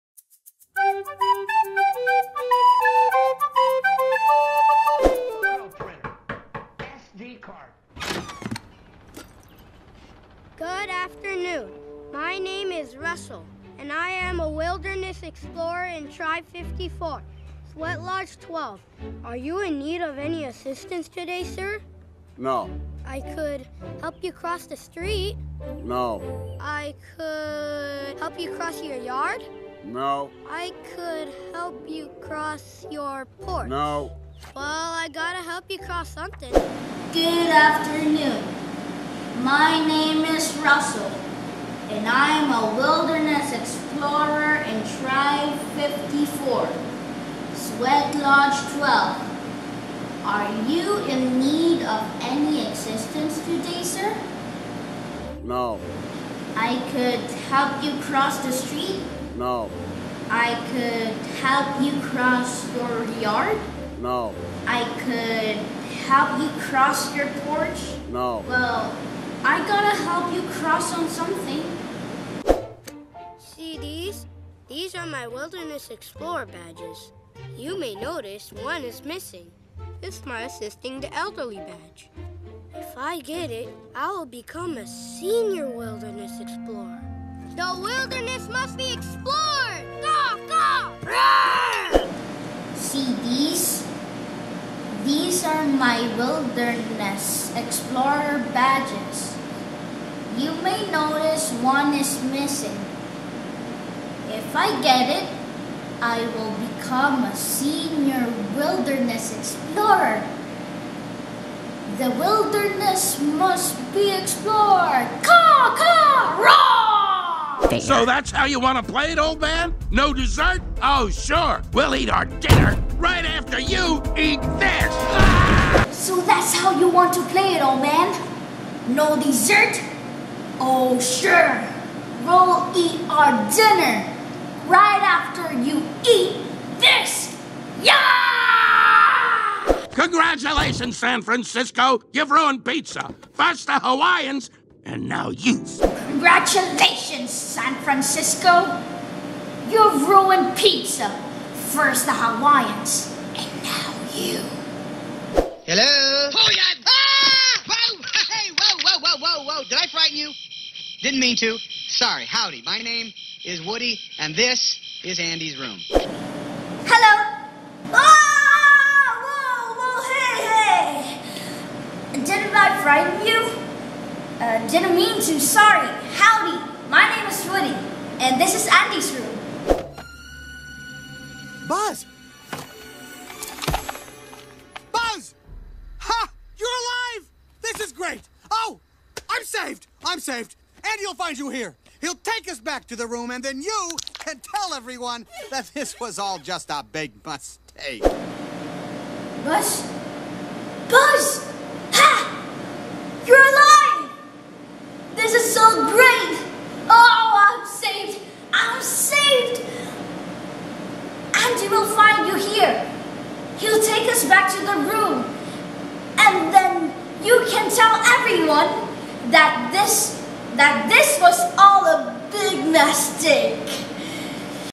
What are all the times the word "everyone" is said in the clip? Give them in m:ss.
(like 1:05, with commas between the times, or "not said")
3:14, 3:38.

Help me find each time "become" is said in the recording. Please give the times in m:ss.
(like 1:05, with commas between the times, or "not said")
1:24, 1:46.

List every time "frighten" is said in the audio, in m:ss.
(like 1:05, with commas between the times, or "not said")
2:39, 2:52.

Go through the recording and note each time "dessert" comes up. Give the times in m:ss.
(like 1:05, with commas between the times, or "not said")
2:00, 2:09.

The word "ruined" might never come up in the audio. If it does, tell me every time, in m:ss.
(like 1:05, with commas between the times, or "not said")
2:22, 2:30.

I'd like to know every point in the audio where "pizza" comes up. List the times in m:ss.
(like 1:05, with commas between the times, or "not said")
2:22, 2:30.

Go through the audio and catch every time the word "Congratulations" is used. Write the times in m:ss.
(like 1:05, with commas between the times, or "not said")
2:19, 2:26.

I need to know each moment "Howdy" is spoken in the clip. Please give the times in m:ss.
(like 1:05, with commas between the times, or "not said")
2:42.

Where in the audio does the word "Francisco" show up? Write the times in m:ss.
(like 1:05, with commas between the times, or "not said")
2:21, 2:27.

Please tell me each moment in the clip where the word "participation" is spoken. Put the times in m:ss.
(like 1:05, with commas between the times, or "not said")
not said.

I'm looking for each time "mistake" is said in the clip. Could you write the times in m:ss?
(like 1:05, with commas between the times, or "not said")
3:17, 3:42.